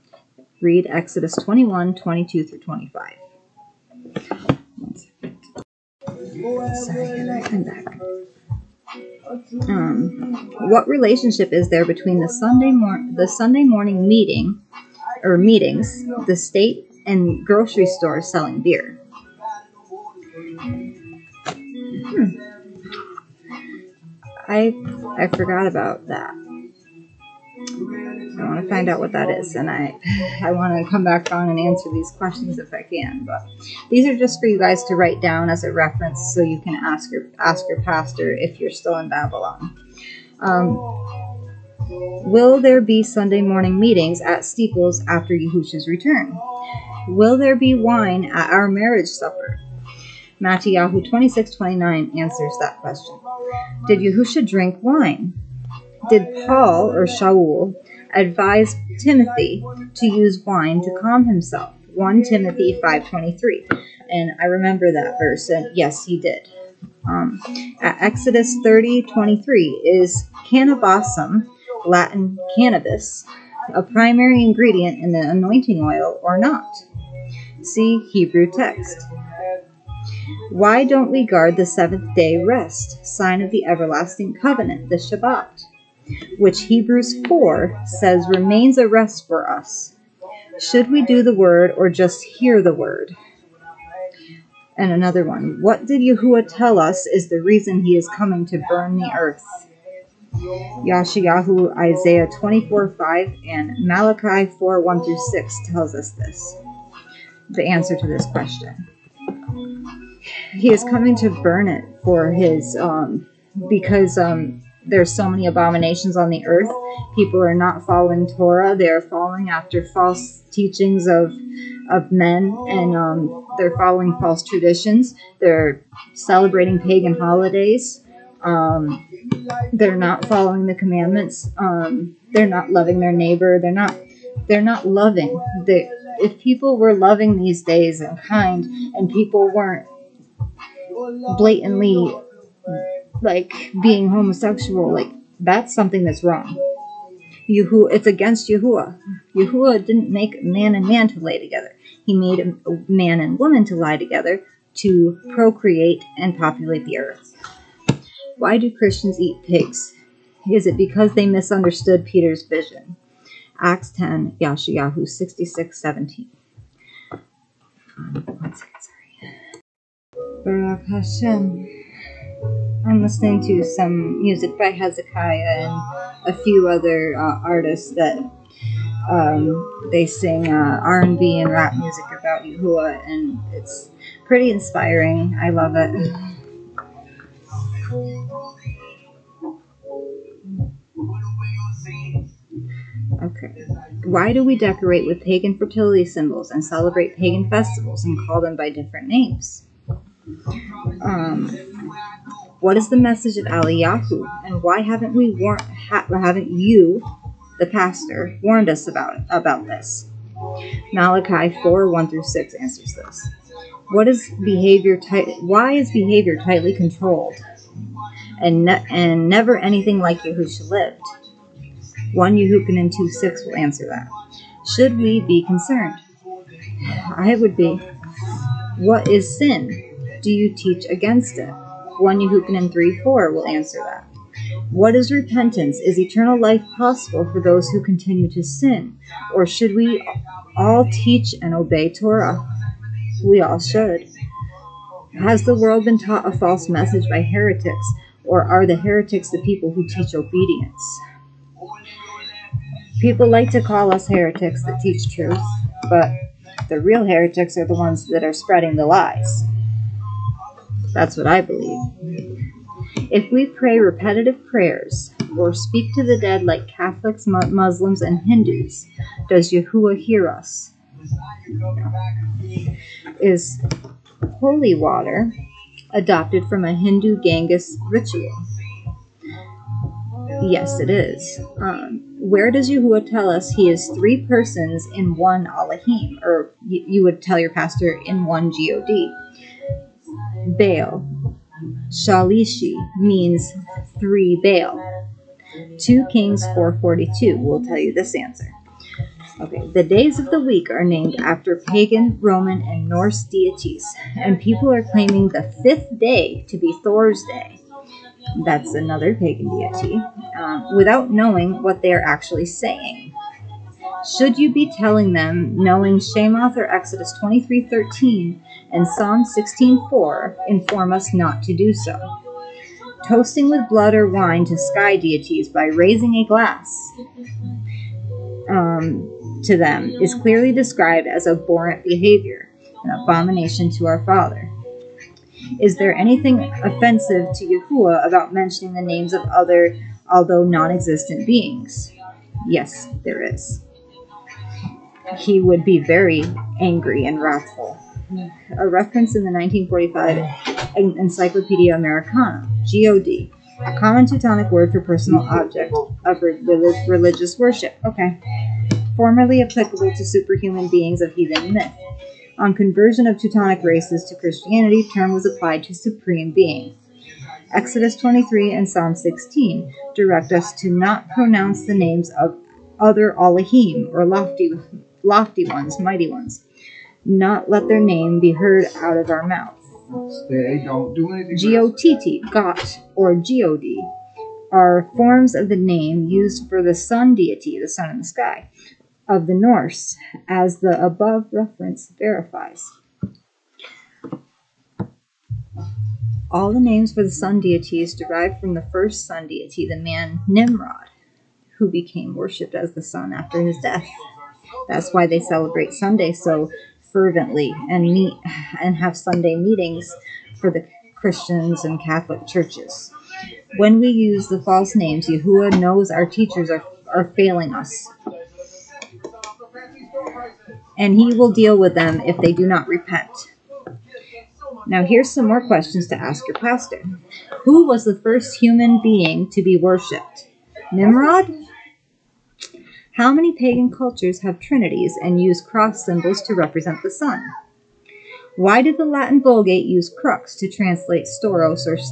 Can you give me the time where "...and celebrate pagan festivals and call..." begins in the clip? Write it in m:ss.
3:16.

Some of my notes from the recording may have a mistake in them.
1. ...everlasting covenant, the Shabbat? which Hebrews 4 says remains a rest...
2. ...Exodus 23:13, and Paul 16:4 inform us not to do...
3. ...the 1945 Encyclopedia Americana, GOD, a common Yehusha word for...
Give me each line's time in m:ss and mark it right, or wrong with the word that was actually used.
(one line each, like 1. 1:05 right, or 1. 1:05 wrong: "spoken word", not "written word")
1. 1:23 right
2. 5:16 wrong: "Psalm", not "Paul"
3. 5:49 wrong: "Teutonic", not "Yehusha".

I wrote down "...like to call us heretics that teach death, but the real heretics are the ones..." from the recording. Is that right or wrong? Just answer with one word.
wrong.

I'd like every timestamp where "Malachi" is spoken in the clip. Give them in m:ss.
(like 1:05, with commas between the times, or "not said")
1:43, 3:30.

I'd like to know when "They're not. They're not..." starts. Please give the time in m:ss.
2:13.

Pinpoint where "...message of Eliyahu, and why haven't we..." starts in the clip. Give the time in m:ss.
3:22.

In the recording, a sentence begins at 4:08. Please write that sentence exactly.
Or are the heretics the people who teach obedience?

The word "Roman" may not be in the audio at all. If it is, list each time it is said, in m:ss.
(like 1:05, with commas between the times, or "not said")
5:02.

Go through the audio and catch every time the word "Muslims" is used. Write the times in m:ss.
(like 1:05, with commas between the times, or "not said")
4:27.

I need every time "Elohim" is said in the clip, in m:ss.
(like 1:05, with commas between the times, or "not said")
4:45, 6:13.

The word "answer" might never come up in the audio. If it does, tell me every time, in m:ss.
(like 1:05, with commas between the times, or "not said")
0:31, 0:52, 1:47, 3:32, 3:43, 3:53, 4:58.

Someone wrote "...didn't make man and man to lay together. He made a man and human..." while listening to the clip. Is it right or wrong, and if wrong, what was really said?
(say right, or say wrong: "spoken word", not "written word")
wrong: "woman", not "human".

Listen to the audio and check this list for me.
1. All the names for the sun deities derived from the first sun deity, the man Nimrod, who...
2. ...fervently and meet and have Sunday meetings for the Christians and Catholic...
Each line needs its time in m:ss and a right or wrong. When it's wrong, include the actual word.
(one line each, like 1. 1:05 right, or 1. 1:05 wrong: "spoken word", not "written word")
1. 6:36 right
2. 6:46 right.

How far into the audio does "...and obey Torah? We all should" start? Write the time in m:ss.
4:01.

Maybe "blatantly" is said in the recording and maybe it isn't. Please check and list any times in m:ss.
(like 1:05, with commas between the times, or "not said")
2:21.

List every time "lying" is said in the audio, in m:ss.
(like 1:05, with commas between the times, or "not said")
not said.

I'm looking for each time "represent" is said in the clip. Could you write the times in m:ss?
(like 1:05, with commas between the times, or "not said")
7:16.